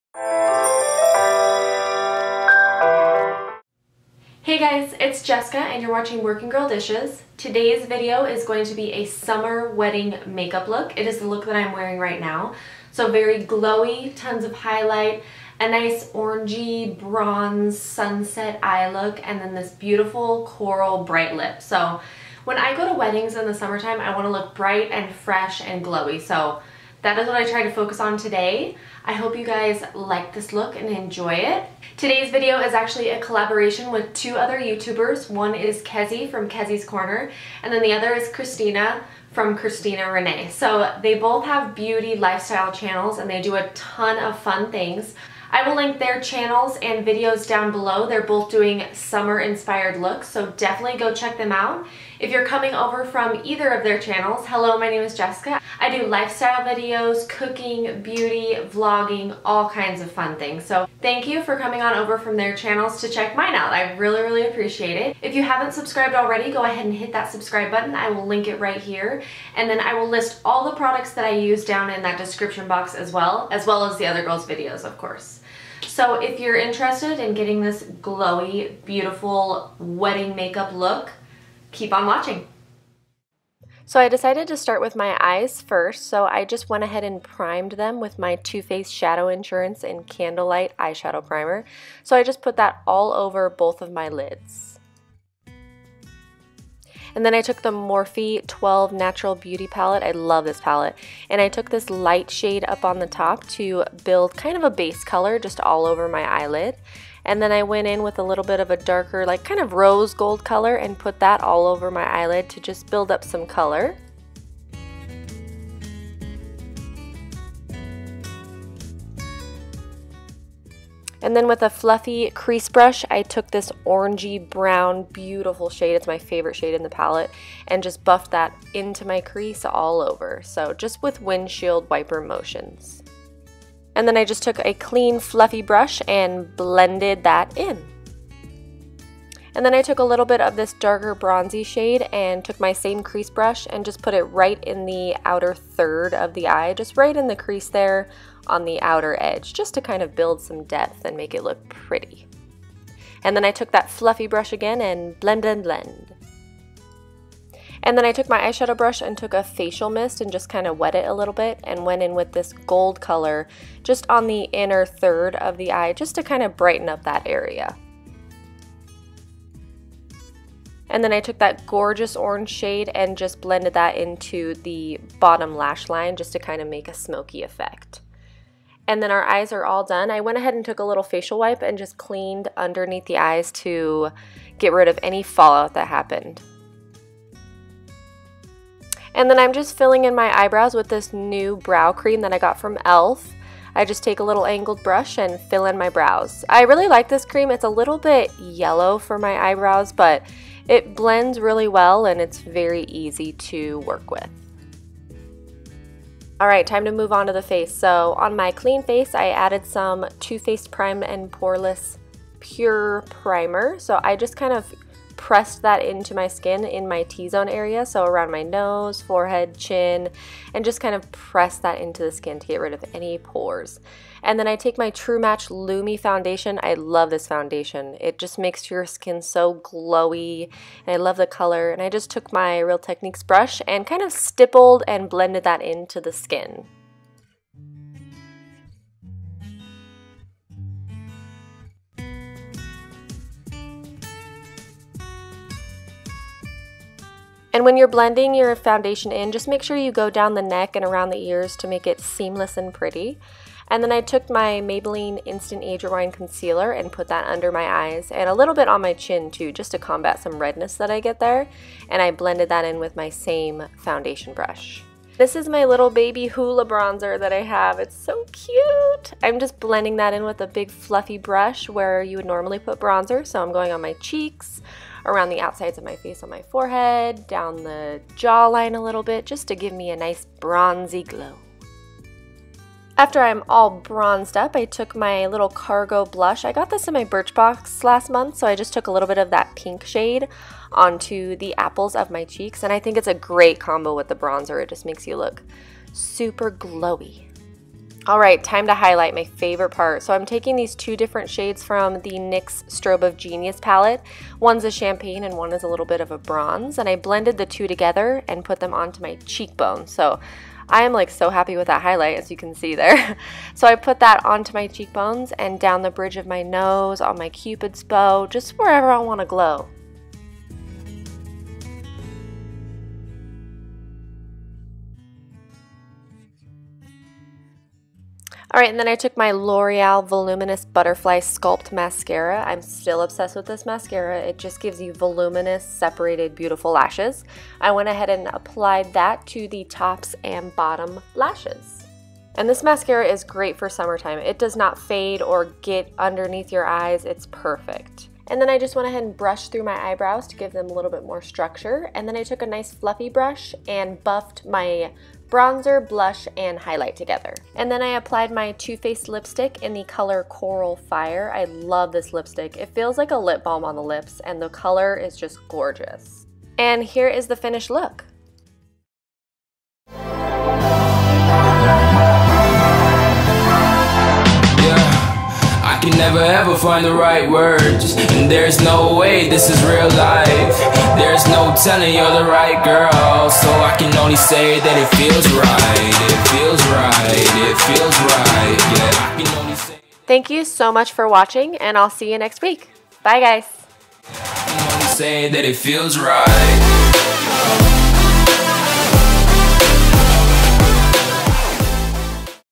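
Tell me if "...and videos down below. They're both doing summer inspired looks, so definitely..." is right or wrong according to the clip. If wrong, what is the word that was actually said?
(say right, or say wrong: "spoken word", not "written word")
right.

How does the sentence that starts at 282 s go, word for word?
After I'm all bronzed up, I took my little cargo blush.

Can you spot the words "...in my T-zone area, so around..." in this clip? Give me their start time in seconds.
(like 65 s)
216 s.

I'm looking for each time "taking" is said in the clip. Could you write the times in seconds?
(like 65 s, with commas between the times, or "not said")
300 s.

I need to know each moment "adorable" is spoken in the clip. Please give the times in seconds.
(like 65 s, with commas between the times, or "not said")
not said.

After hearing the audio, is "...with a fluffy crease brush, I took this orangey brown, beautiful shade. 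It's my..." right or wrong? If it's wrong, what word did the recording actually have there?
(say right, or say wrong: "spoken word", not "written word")
right.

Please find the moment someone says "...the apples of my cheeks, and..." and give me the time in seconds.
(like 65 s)
291 s.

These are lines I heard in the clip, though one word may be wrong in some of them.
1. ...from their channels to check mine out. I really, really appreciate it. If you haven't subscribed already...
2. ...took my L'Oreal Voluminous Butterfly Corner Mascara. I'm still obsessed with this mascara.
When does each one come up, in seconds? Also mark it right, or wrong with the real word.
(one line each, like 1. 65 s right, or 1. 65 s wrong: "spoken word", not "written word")
1. 62 s right
2. 328 s wrong: "Sculpt", not "Corner".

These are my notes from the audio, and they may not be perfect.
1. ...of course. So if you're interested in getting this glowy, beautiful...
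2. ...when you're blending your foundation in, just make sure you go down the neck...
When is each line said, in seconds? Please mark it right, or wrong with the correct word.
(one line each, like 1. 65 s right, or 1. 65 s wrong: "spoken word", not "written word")
1. 74 s right
2. 247 s right.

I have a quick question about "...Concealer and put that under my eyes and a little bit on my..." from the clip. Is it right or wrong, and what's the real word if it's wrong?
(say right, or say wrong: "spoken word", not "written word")
right.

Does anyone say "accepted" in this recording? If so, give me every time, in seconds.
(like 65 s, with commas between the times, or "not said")
not said.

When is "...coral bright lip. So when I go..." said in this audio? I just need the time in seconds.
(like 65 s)
20 s.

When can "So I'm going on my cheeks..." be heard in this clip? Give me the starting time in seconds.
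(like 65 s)
273 s.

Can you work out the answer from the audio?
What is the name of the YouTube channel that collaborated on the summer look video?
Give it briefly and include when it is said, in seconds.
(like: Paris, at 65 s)
Kezzie's Corner, at 36 s.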